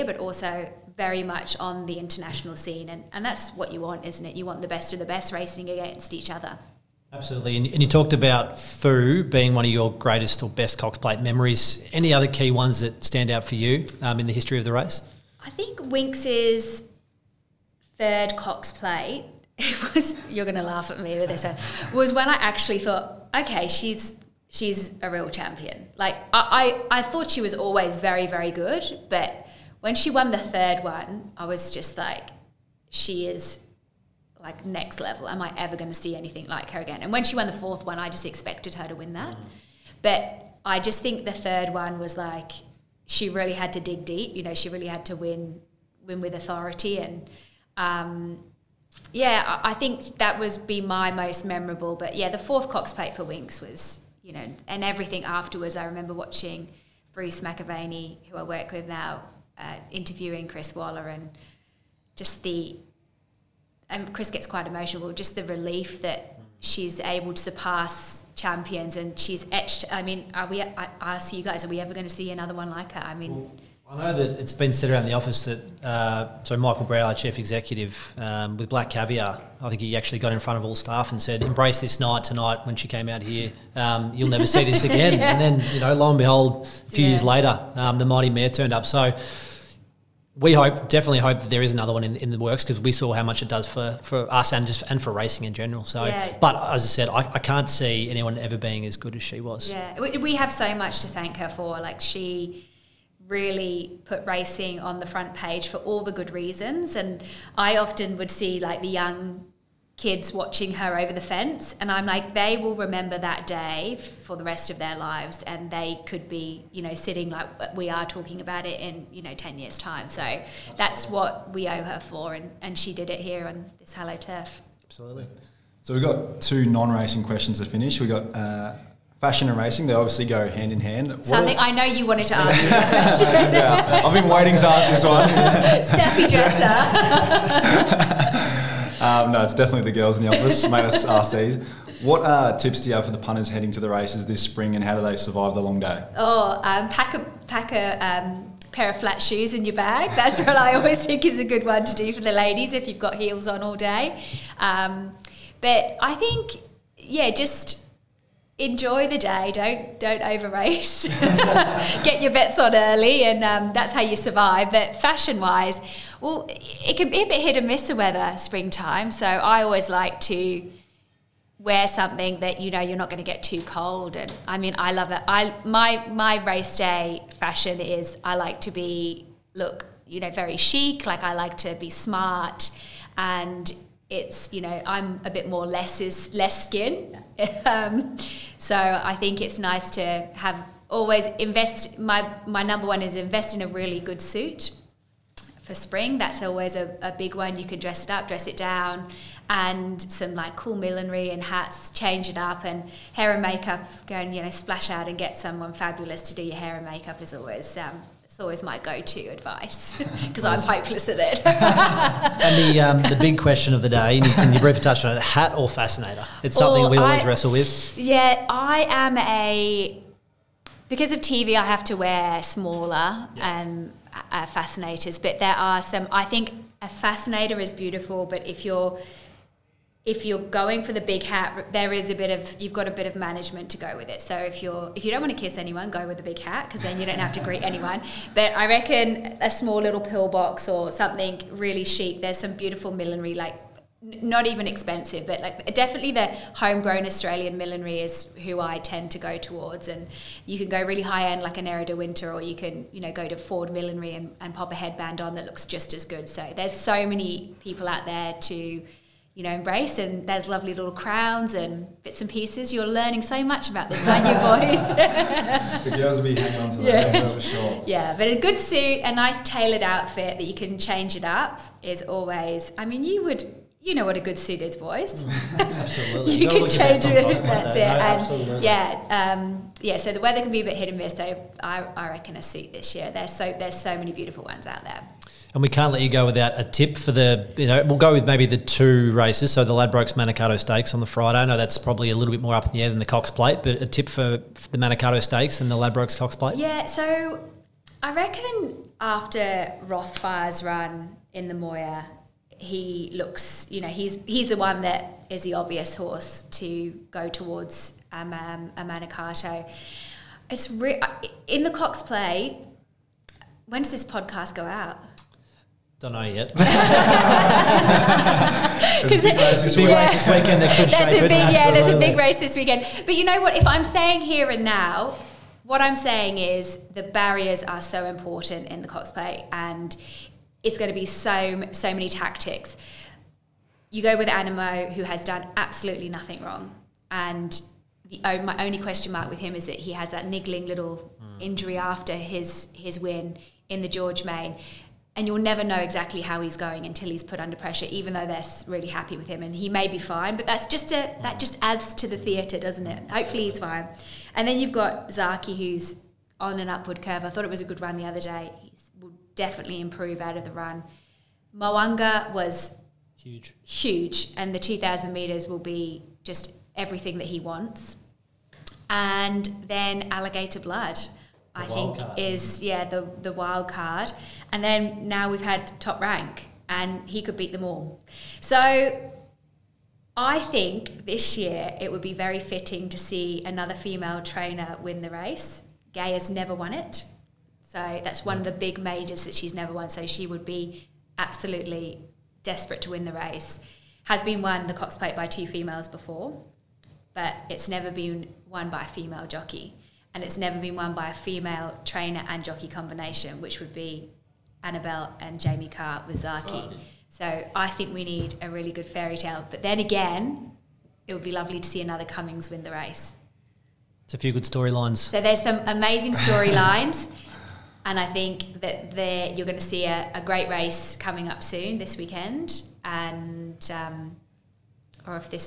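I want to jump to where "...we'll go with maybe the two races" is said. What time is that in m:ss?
4:47.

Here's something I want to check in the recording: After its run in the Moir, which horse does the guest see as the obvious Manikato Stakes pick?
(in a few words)
Rothfire.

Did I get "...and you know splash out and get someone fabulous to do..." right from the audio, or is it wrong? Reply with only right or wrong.
right.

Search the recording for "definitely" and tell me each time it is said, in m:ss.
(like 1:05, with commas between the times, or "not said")
1:30, 2:19, 4:05, 5:59.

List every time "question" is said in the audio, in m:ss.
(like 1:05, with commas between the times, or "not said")
2:07, 3:33, 5:38.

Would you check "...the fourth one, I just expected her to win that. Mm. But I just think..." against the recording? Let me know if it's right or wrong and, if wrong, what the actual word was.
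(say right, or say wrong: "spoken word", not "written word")
right.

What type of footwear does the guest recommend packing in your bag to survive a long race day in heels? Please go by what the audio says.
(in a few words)
Flat shoes.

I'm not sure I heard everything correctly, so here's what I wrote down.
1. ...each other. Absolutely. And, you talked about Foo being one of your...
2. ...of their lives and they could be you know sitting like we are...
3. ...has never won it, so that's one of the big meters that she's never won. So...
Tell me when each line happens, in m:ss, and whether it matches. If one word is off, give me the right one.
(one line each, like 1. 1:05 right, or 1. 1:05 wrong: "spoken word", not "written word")
1. 0:06 right
2. 1:54 right
3. 6:26 wrong: "majors", not "meters".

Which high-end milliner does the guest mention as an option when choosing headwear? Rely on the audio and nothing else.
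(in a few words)
Era de Winter.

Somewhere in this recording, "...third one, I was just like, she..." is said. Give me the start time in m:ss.
0:30.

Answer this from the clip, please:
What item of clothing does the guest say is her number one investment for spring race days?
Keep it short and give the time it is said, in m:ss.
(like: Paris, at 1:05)
A really good suit, at 3:13.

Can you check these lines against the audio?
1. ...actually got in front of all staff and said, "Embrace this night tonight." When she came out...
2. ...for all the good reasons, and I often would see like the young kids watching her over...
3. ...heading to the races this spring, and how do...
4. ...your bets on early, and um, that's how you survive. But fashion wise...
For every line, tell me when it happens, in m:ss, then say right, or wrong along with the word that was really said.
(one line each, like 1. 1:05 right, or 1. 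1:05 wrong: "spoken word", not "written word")
1. 1:19 right
2. 1:45 right
3. 2:23 right
4. 2:42 right.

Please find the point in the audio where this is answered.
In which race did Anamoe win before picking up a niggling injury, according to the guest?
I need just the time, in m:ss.
5:43.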